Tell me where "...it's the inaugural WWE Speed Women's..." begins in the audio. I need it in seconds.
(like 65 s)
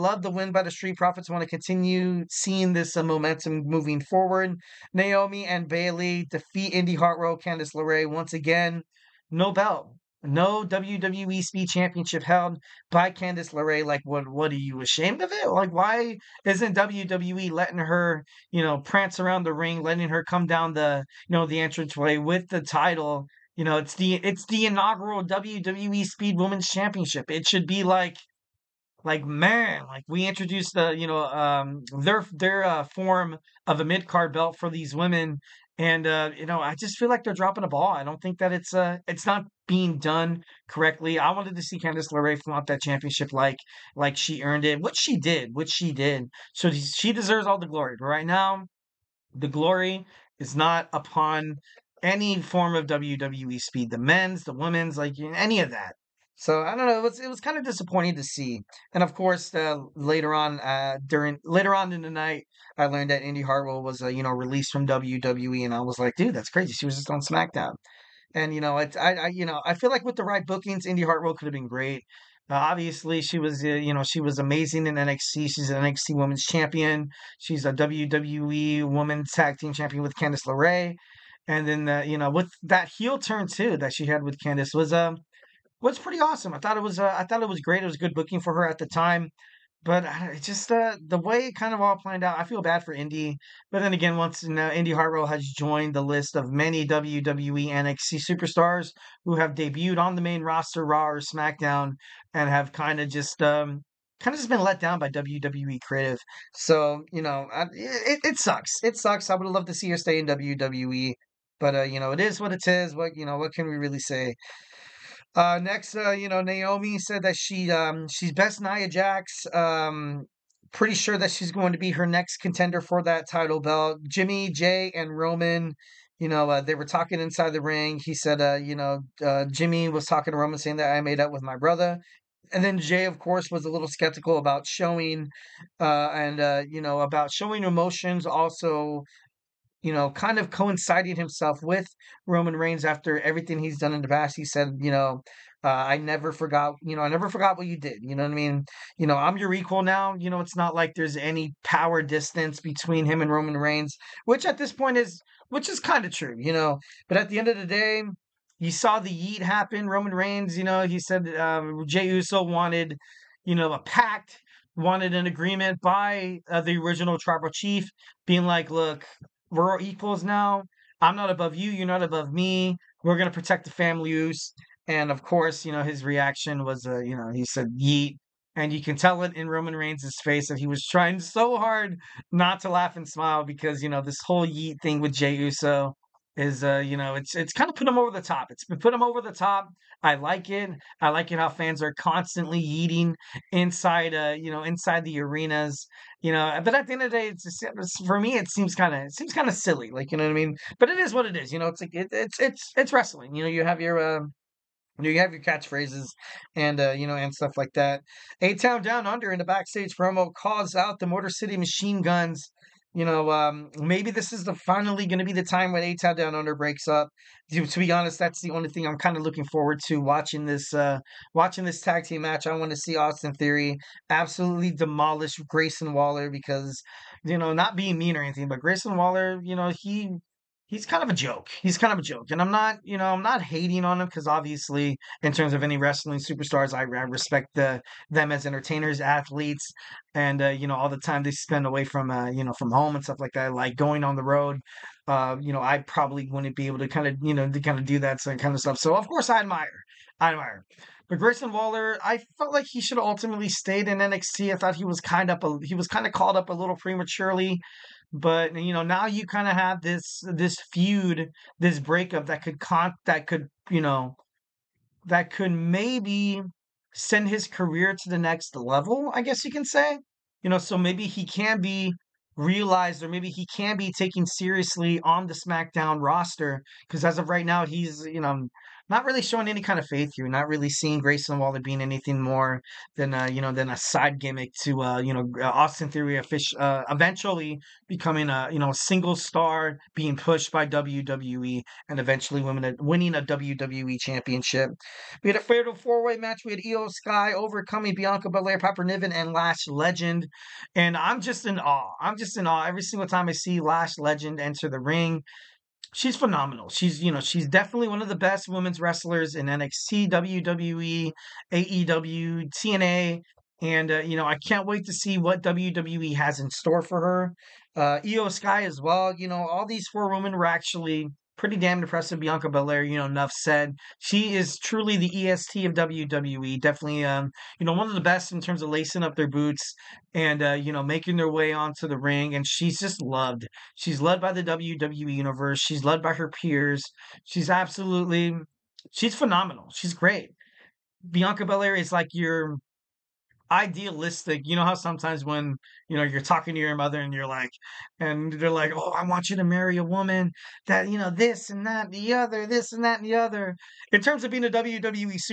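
24 s.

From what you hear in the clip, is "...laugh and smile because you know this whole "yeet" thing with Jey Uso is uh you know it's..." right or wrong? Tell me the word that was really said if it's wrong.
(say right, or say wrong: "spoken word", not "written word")
right.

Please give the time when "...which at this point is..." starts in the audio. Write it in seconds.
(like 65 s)
154 s.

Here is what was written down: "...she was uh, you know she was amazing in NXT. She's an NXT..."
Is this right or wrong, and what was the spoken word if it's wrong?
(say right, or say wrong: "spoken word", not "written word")
right.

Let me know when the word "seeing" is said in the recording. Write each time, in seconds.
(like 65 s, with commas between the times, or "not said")
2 s, 280 s.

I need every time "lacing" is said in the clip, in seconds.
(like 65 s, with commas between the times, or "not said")
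328 s.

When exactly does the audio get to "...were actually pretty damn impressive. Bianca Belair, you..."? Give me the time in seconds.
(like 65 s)
320 s.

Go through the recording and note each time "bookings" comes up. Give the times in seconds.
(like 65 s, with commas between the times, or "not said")
70 s, 88 s.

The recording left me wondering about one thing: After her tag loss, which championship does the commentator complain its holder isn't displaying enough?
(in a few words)
WWE Speed Championship.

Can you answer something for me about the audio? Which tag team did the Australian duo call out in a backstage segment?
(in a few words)
Motor City Machine Guns.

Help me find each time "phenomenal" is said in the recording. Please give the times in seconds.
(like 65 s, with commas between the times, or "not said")
306 s, 339 s.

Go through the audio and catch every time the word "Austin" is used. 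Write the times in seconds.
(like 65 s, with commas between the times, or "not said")
222 s, 285 s.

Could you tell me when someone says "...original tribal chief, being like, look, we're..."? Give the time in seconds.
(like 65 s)
166 s.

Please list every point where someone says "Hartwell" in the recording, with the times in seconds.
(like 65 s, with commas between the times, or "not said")
6 s, 63 s, 71 s, 94 s.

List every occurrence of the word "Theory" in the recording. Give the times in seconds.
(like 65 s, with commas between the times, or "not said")
223 s, 285 s.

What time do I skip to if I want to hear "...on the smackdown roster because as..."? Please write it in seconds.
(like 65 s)
275 s.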